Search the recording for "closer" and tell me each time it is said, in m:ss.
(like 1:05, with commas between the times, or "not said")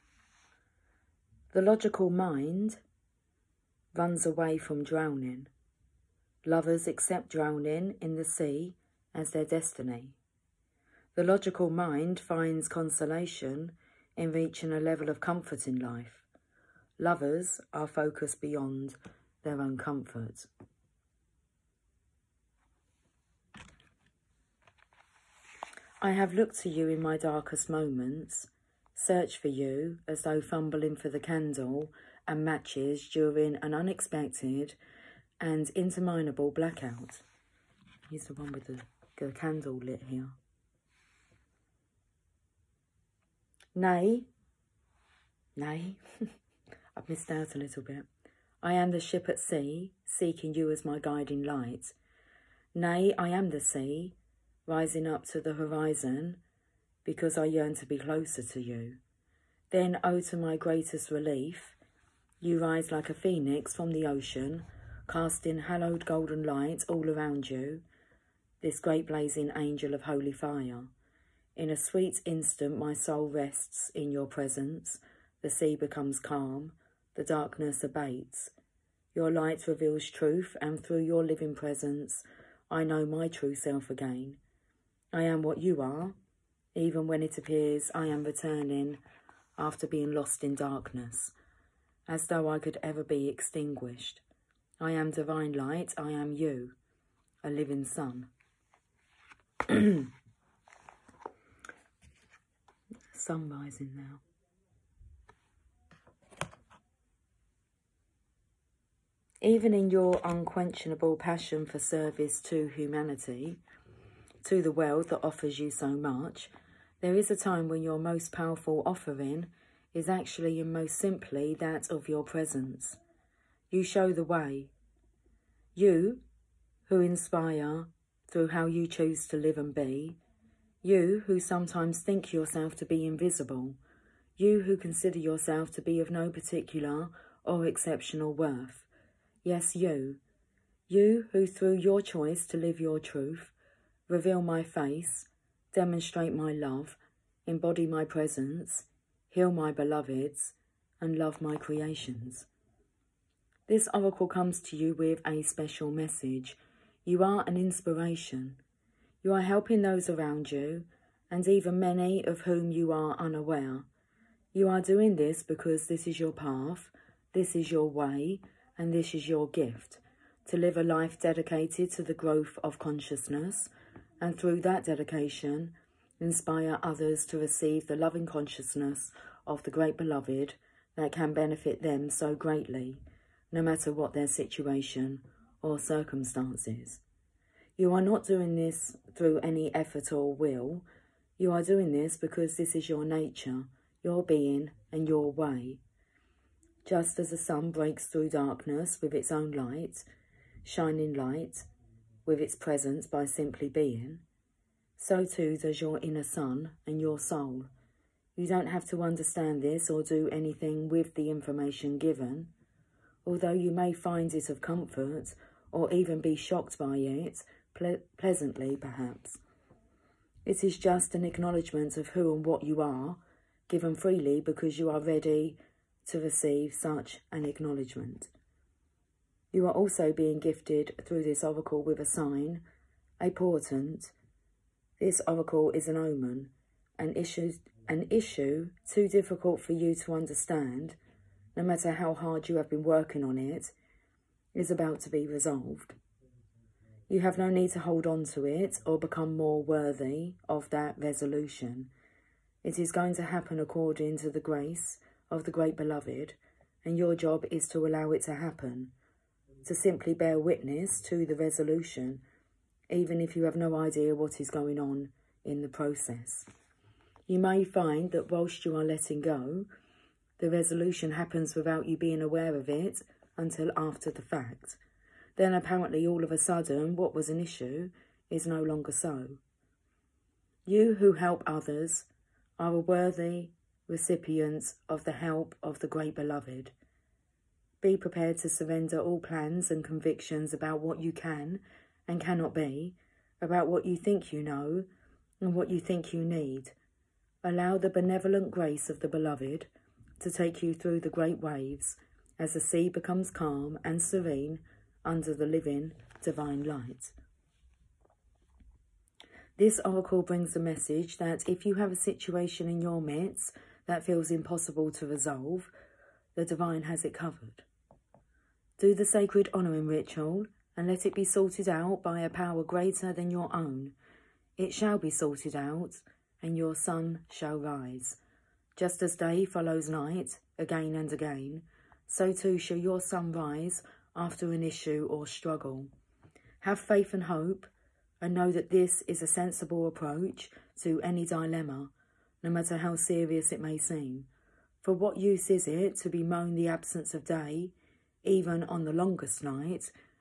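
0:57.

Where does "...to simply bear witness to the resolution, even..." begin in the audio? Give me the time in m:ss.
4:19.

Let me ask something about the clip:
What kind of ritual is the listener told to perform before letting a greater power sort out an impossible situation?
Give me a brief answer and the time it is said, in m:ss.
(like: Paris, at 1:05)
Sacred honouring ritual, at 5:19.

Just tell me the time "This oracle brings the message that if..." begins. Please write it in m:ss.
5:09.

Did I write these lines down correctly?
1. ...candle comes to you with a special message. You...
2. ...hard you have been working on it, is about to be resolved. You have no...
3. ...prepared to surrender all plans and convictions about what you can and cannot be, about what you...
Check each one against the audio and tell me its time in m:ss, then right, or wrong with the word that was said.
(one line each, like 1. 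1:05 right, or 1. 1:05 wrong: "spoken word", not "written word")
1. 2:33 wrong: "oracle", not "candle"
2. 4:02 right
3. 4:47 right.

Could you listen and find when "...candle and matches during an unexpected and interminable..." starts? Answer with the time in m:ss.
0:31.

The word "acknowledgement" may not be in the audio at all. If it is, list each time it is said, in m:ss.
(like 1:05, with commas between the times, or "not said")
3:41, 3:47.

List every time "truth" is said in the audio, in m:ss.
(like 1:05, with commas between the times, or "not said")
1:20, 2:23.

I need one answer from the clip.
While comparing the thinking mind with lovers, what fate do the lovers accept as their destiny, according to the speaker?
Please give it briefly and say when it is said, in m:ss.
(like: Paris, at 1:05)
Drowning in the sea, at 0:07.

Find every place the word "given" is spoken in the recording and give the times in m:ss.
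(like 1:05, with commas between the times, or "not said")
3:31, 3:43.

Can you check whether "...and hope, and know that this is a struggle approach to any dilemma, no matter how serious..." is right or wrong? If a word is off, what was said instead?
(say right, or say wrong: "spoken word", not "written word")
wrong: "sensible", not "struggle".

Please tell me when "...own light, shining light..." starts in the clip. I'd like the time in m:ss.
3:19.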